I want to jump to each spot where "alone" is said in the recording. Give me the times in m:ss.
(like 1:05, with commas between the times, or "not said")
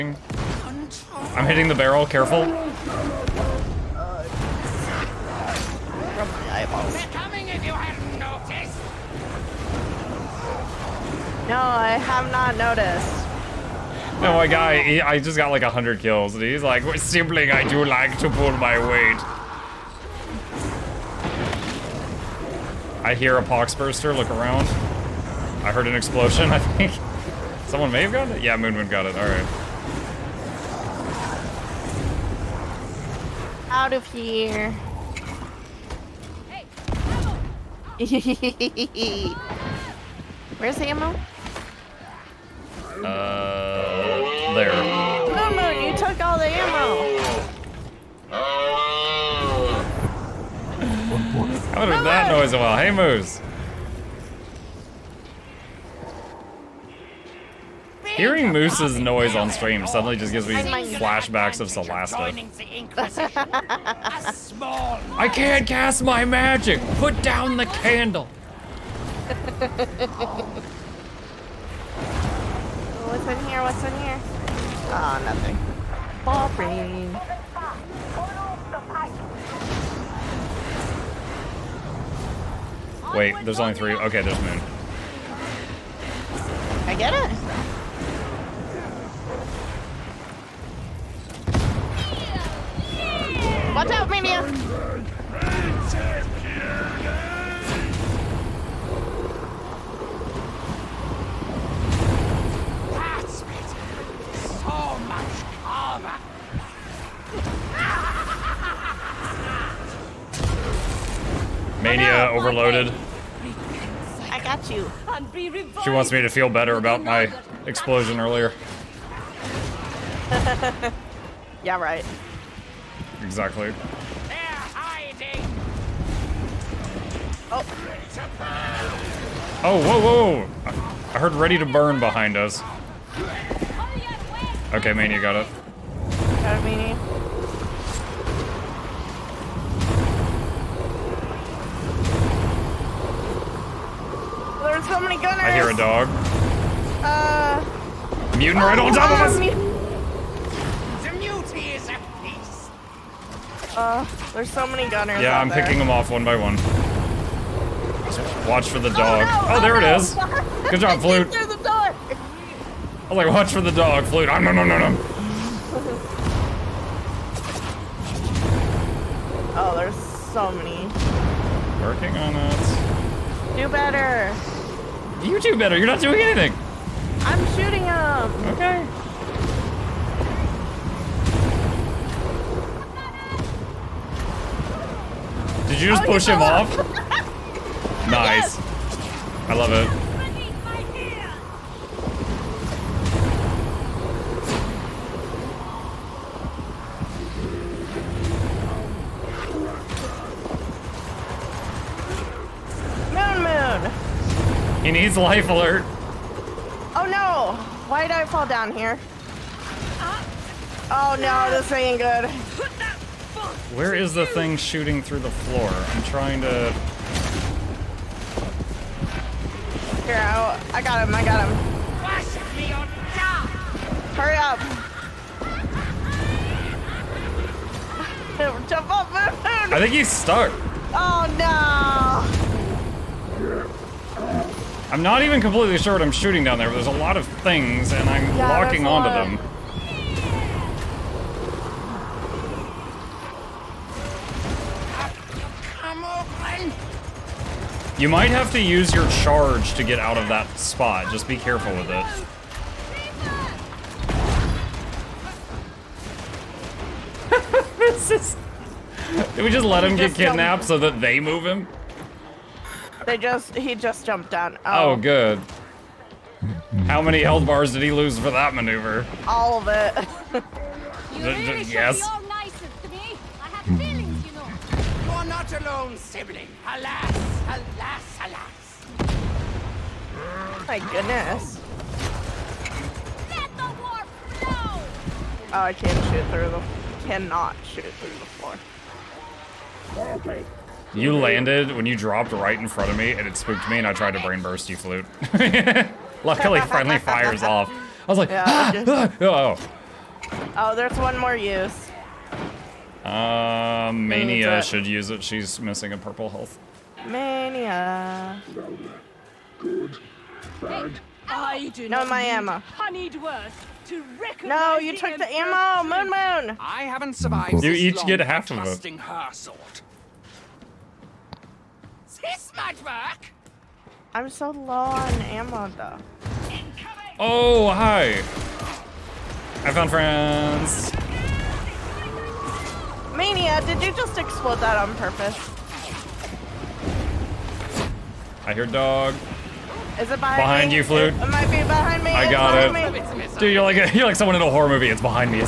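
4:35.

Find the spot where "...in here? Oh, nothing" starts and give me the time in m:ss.
1:13.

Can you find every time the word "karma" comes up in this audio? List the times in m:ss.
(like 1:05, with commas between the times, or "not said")
1:45.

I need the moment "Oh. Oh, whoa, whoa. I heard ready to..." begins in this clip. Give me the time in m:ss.
2:07.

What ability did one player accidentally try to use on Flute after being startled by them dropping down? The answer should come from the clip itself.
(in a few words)
brain burst.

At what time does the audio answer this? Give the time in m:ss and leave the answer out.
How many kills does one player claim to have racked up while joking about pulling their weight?
0:15.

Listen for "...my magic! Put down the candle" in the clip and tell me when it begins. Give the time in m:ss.
1:06.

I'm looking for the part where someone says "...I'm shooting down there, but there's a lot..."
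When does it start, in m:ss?
3:56.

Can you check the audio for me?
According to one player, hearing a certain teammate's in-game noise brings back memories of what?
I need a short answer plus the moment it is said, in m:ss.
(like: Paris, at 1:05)
Celasta, at 1:01.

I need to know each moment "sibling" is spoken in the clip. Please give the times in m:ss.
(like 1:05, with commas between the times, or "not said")
0:16, 4:35.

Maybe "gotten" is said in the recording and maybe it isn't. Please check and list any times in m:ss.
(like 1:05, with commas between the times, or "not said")
0:28.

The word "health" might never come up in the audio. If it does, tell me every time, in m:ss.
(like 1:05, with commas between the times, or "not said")
4:27, 5:06.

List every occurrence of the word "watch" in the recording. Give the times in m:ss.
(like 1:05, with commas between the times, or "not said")
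1:33, 2:38, 2:43.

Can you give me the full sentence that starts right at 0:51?
How did that noise a while?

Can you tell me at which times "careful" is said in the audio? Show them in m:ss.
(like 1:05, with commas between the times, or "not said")
0:02, 4:11.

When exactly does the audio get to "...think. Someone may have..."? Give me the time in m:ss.
0:26.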